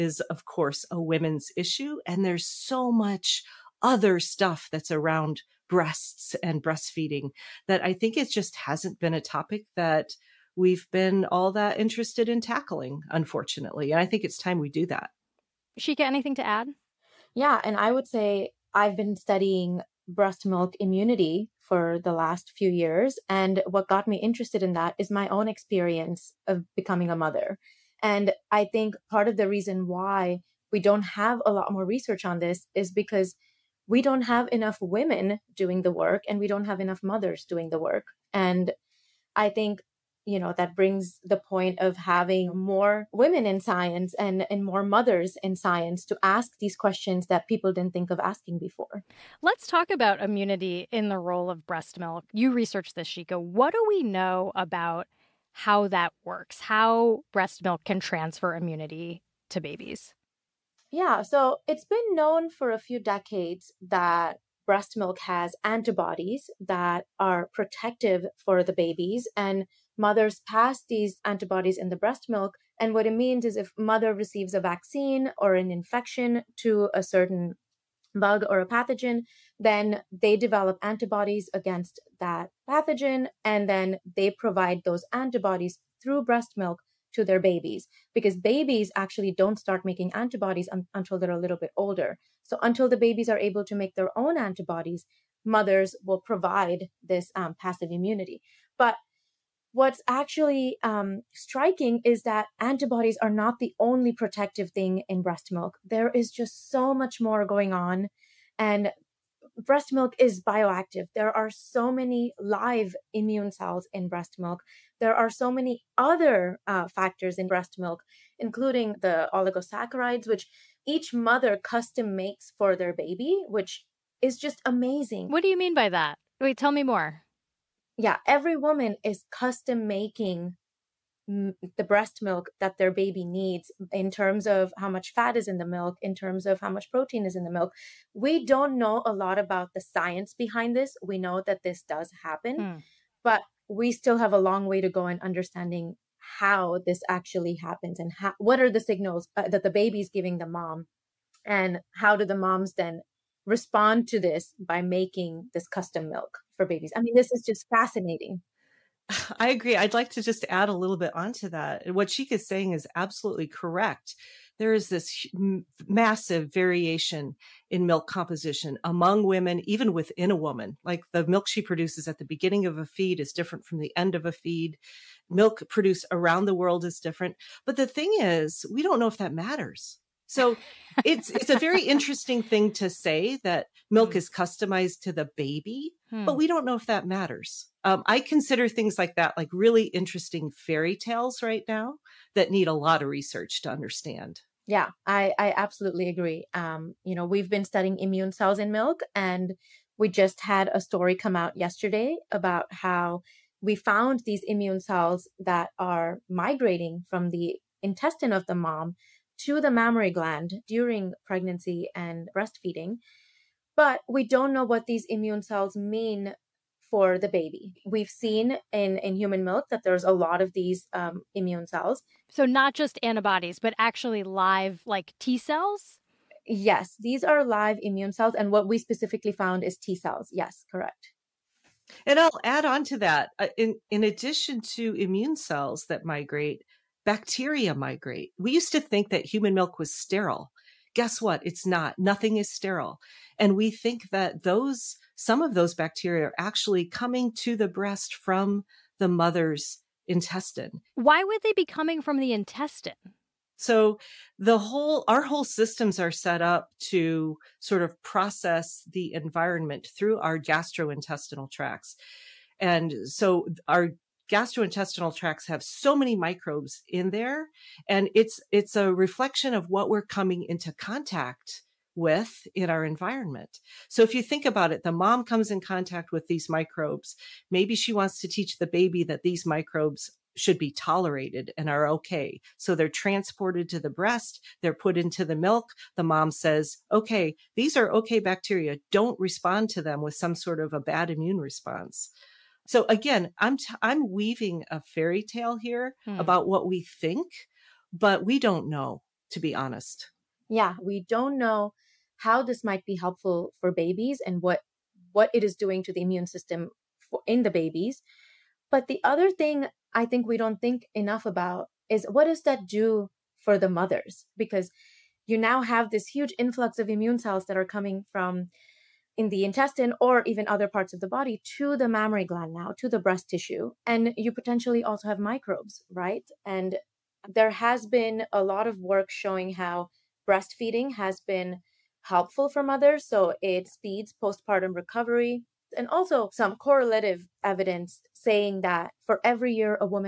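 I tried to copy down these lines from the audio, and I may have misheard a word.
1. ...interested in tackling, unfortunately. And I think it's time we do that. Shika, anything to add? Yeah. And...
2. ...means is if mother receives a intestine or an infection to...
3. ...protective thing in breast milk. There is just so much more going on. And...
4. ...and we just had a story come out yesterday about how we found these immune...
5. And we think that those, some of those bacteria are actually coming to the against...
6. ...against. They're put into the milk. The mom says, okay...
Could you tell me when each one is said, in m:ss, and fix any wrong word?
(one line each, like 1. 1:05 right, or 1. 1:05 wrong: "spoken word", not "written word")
1. 0:11 right
2. 1:13 wrong: "vaccine", not "intestine"
3. 1:44 right
4. 3:19 right
5. 4:03 wrong: "breast", not "against"
6. 4:43 wrong: "breast", not "against".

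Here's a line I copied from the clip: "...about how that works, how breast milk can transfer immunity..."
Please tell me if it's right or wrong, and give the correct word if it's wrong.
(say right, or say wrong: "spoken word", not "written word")
right.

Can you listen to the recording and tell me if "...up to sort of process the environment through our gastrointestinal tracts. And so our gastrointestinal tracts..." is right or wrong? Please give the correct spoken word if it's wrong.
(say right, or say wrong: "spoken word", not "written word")
right.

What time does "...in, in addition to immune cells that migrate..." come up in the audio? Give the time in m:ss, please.
3:53.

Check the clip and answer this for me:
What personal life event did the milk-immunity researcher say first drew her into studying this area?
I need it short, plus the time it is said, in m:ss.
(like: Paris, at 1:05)
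Becoming a mother, at 0:26.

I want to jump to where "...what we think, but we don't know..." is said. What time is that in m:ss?
4:56.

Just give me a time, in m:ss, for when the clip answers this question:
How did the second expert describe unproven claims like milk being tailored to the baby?
3:09.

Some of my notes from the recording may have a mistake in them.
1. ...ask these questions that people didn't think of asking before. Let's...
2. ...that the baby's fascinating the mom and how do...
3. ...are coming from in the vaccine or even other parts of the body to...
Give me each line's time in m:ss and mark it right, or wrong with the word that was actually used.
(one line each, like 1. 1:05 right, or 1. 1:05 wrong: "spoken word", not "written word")
1. 0:46 right
2. 2:29 wrong: "giving", not "fascinating"
3. 5:17 wrong: "intestine", not "vaccine".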